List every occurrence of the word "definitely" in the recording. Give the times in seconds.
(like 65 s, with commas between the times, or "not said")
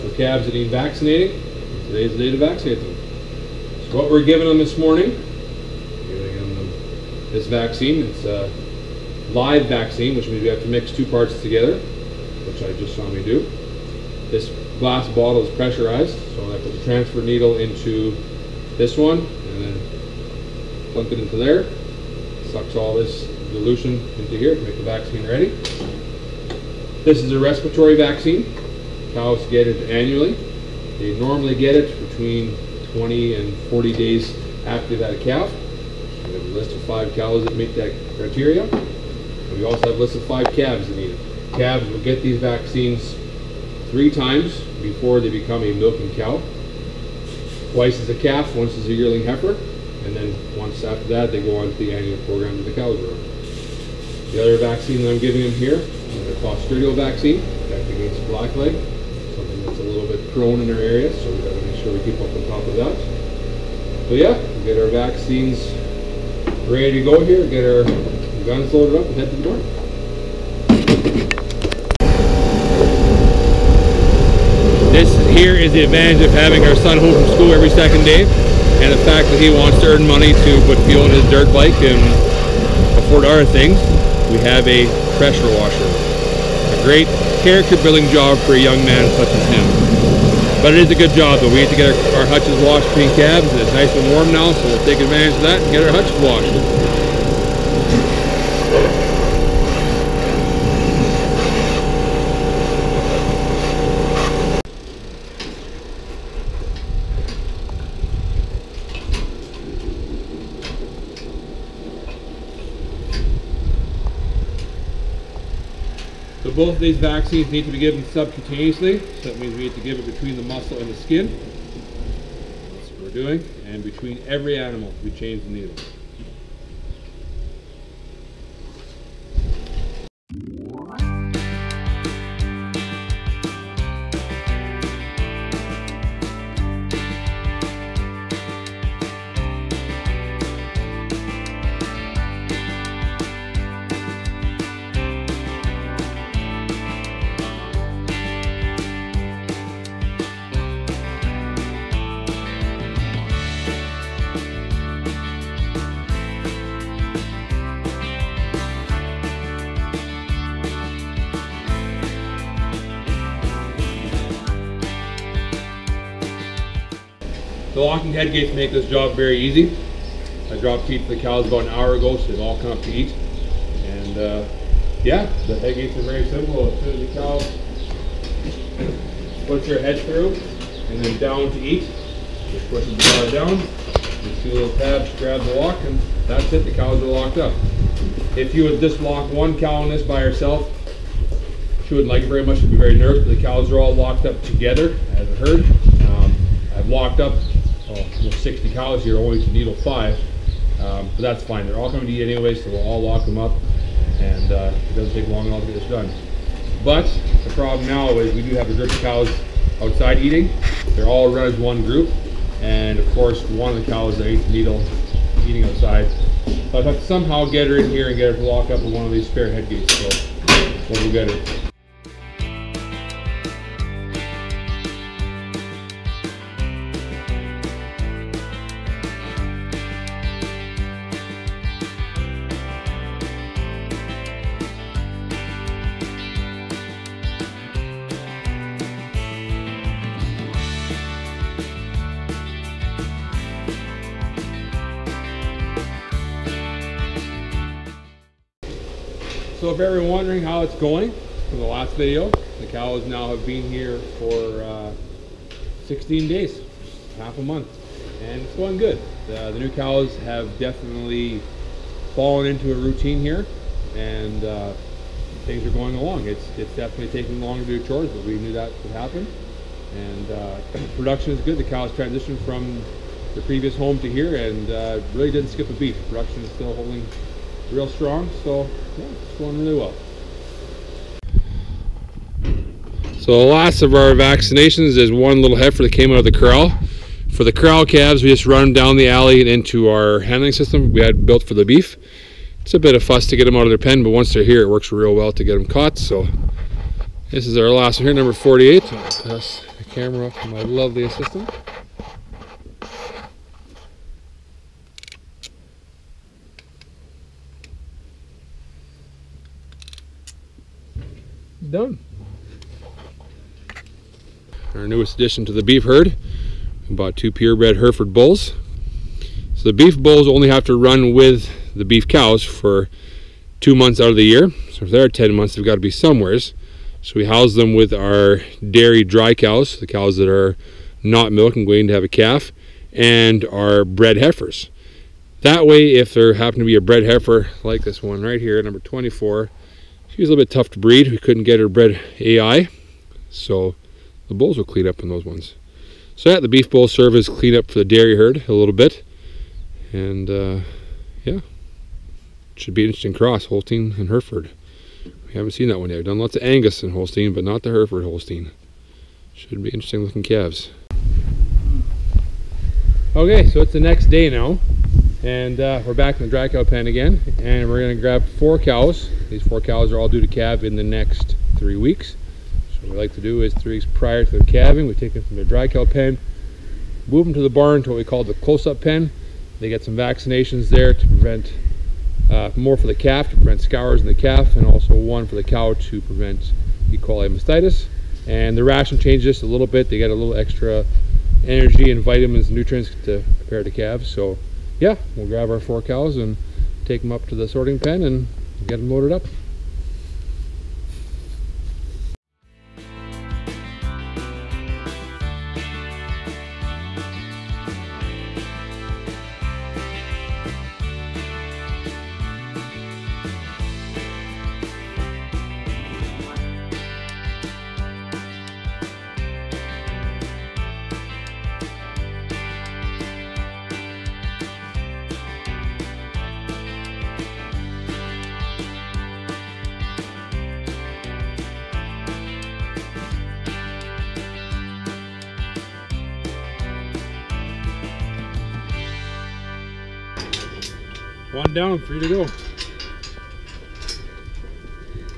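260 s, 266 s.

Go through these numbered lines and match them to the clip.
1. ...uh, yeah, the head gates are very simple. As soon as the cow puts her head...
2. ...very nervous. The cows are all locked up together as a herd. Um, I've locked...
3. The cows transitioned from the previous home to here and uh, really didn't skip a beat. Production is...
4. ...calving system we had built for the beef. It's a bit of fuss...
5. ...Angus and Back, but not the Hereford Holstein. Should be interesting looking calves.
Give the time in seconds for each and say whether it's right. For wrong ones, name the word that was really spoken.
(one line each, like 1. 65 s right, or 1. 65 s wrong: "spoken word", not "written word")
1. 174 s right
2. 192 s right
3. 271 s right
4. 290 s wrong: "handling", not "calving"
5. 356 s wrong: "Holstein", not "Back".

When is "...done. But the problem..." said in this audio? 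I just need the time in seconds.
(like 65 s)
205 s.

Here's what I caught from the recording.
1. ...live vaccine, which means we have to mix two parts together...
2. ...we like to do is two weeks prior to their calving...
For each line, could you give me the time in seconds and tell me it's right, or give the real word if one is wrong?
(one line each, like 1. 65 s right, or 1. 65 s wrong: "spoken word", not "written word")
1. 9 s right
2. 372 s wrong: "three", not "two".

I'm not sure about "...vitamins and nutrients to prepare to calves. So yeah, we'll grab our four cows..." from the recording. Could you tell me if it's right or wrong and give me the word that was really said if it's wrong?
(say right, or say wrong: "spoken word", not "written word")
right.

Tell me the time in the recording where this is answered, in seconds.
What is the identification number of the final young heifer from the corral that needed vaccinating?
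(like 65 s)
298 s.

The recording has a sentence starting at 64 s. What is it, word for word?
So yeah, get our vaccines ready to go here, get our guns loaded up and head to the door.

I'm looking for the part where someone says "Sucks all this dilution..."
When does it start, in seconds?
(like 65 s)
22 s.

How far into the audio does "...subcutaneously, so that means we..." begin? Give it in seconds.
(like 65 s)
118 s.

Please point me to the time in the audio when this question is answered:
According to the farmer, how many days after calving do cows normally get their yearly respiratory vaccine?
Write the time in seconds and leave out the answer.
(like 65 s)
32 s.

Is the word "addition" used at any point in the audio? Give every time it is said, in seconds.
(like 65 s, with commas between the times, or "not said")
315 s.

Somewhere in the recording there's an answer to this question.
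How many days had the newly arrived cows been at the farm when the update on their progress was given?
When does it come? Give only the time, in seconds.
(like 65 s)
255 s.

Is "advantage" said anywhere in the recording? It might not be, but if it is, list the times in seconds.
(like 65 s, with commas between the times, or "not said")
75 s, 94 s.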